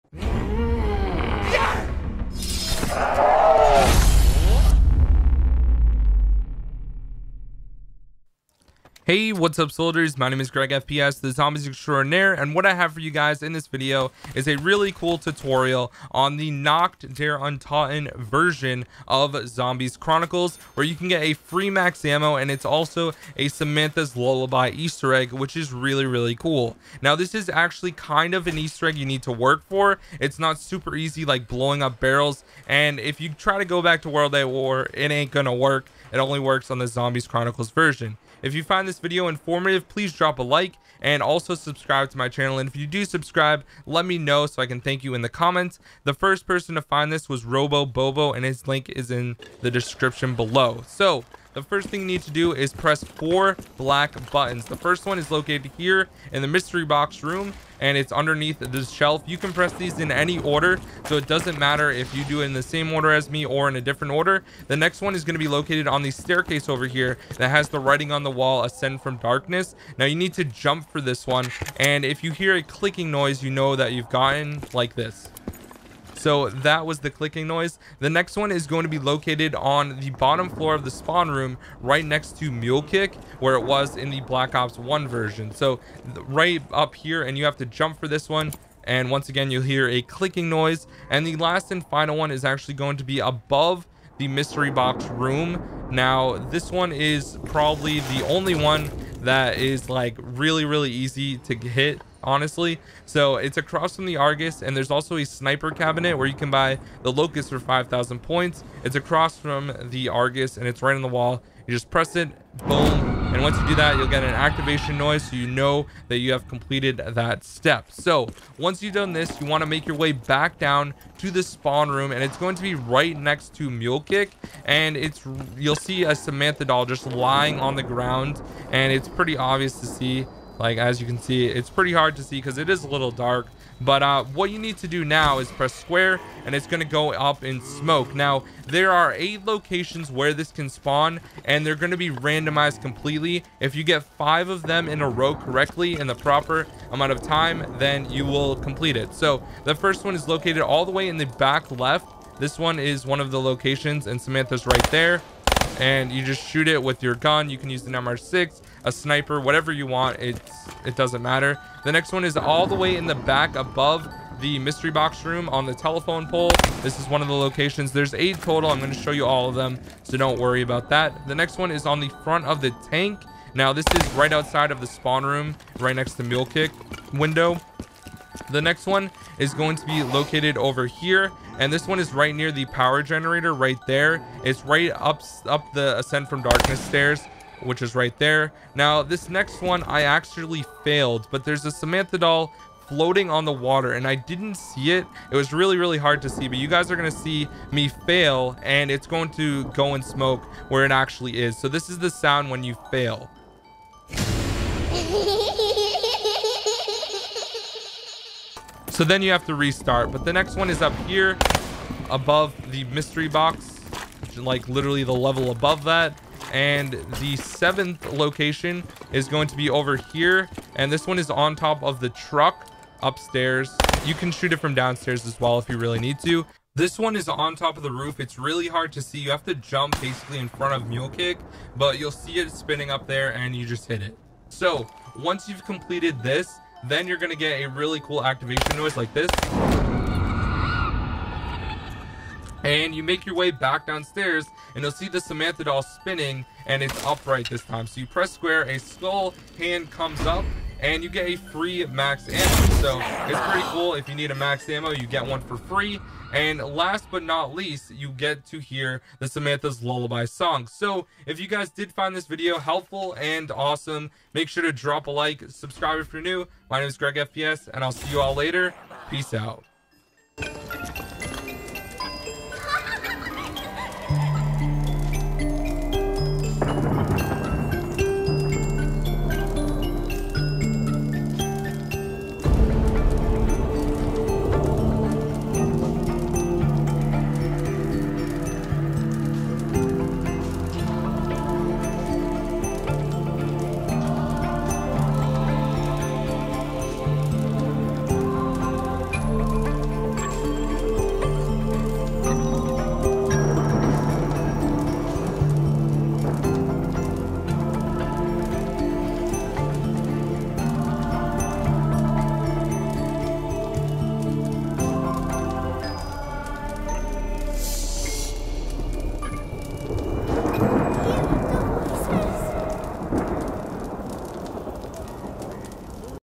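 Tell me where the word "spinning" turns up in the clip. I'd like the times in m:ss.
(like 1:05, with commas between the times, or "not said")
3:52, 4:05.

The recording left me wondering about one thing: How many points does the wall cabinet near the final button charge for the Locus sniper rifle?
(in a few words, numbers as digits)
5,000.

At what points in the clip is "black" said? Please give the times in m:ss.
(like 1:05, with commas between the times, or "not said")
0:53, 1:24.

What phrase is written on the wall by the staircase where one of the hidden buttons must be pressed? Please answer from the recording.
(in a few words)
Ascend from Darkness.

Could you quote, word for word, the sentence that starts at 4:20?
So if you guys did find this video helpful and awesome, make sure to drop a like, subscribe if you're new.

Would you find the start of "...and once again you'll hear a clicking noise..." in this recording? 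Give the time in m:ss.
1:28.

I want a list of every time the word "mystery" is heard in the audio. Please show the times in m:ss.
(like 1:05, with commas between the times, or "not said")
0:56, 1:34, 2:44, 3:32.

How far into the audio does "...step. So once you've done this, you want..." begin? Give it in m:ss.
1:57.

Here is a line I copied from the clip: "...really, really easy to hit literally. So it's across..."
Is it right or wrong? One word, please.
wrong.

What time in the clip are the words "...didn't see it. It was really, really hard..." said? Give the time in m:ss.
3:14.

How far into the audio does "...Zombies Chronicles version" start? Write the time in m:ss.
0:36.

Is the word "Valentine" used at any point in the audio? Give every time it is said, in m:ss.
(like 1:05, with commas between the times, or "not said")
not said.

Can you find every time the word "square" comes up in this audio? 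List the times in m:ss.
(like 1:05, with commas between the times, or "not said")
2:15, 4:08.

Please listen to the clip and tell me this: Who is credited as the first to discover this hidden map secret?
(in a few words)
Robo Bobo.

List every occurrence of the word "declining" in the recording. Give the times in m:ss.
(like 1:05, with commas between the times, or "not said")
not said.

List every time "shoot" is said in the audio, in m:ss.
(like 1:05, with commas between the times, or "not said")
2:36, 3:44.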